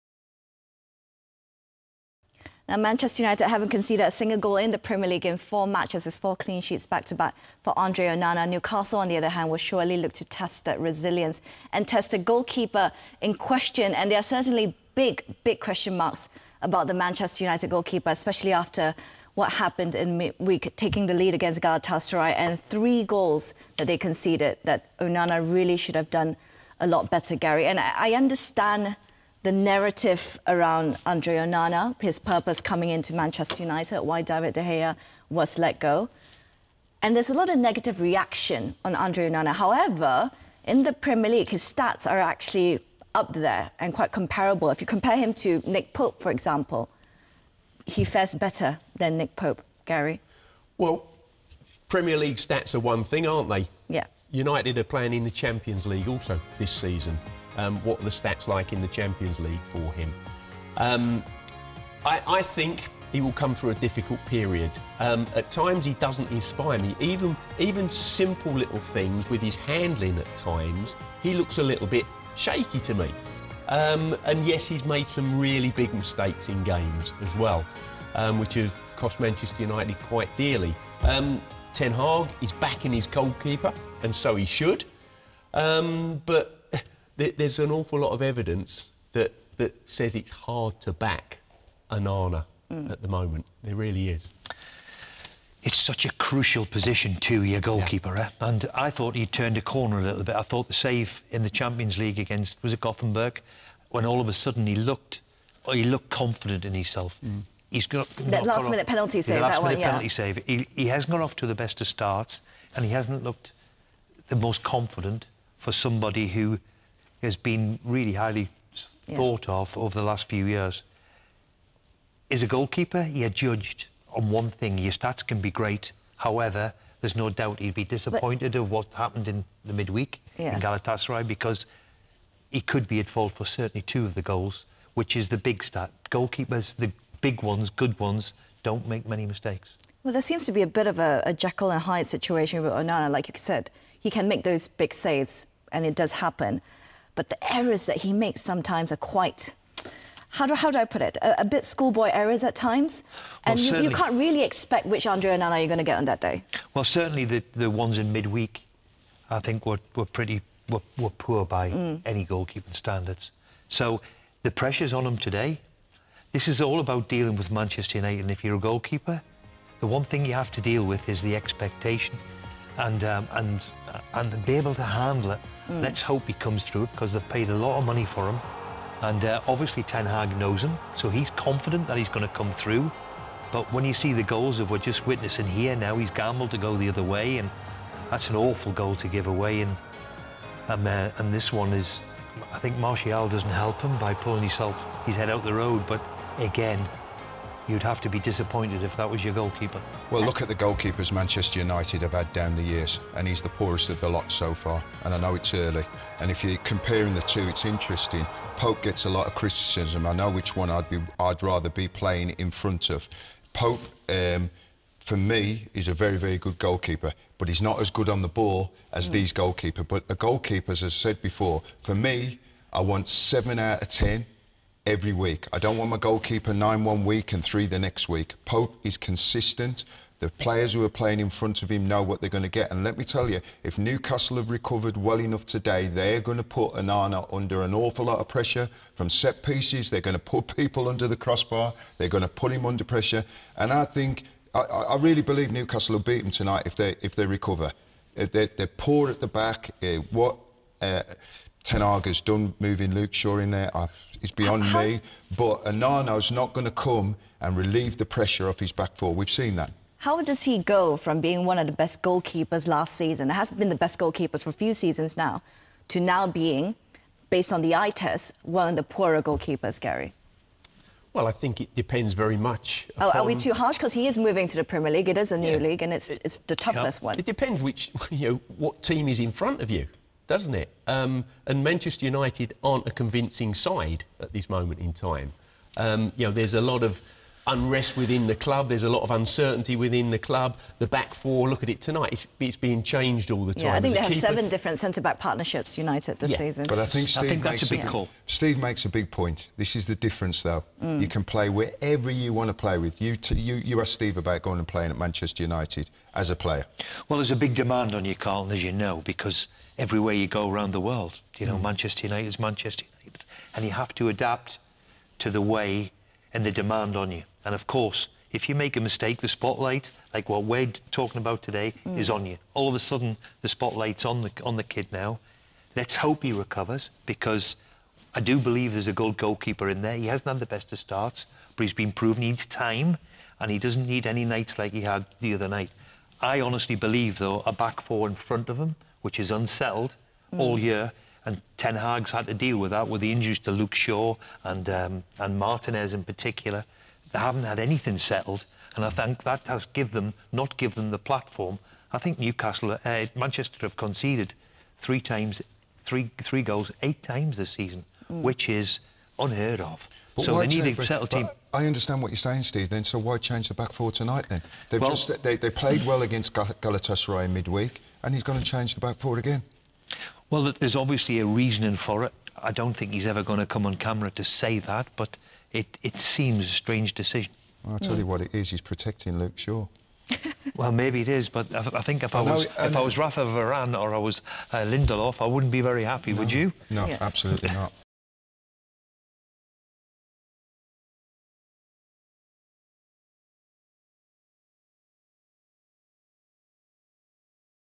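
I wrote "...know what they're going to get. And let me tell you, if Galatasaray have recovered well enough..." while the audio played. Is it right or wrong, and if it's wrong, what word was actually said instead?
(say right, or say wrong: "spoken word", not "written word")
wrong: "Newcastle", not "Galatasaray".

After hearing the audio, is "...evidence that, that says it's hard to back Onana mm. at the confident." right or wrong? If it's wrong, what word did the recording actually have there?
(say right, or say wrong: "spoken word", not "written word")
wrong: "moment", not "confident".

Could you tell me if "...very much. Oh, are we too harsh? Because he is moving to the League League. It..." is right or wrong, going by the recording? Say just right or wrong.
wrong.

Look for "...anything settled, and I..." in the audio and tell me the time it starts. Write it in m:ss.
5:47.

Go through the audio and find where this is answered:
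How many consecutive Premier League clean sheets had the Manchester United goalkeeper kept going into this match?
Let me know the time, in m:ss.
0:06.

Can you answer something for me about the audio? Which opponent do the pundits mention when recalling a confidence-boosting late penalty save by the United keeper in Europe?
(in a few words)
Gothenburg.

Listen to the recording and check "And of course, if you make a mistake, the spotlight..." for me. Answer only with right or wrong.
right.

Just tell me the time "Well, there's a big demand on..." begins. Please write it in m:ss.
5:07.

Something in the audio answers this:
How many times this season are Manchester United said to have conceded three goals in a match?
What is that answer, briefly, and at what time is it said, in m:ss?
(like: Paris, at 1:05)
8, at 5:56.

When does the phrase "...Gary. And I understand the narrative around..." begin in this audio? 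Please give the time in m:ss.
0:27.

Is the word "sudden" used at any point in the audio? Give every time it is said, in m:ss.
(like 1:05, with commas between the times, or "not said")
1:44, 5:22.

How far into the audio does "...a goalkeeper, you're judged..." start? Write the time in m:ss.
2:02.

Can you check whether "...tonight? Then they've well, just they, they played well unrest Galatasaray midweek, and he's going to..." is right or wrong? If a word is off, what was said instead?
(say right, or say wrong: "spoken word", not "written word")
wrong: "against", not "unrest".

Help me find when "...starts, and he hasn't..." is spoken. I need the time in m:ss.
1:51.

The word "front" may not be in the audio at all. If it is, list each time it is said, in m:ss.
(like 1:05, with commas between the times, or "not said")
3:32, 3:51, 4:39, 5:38.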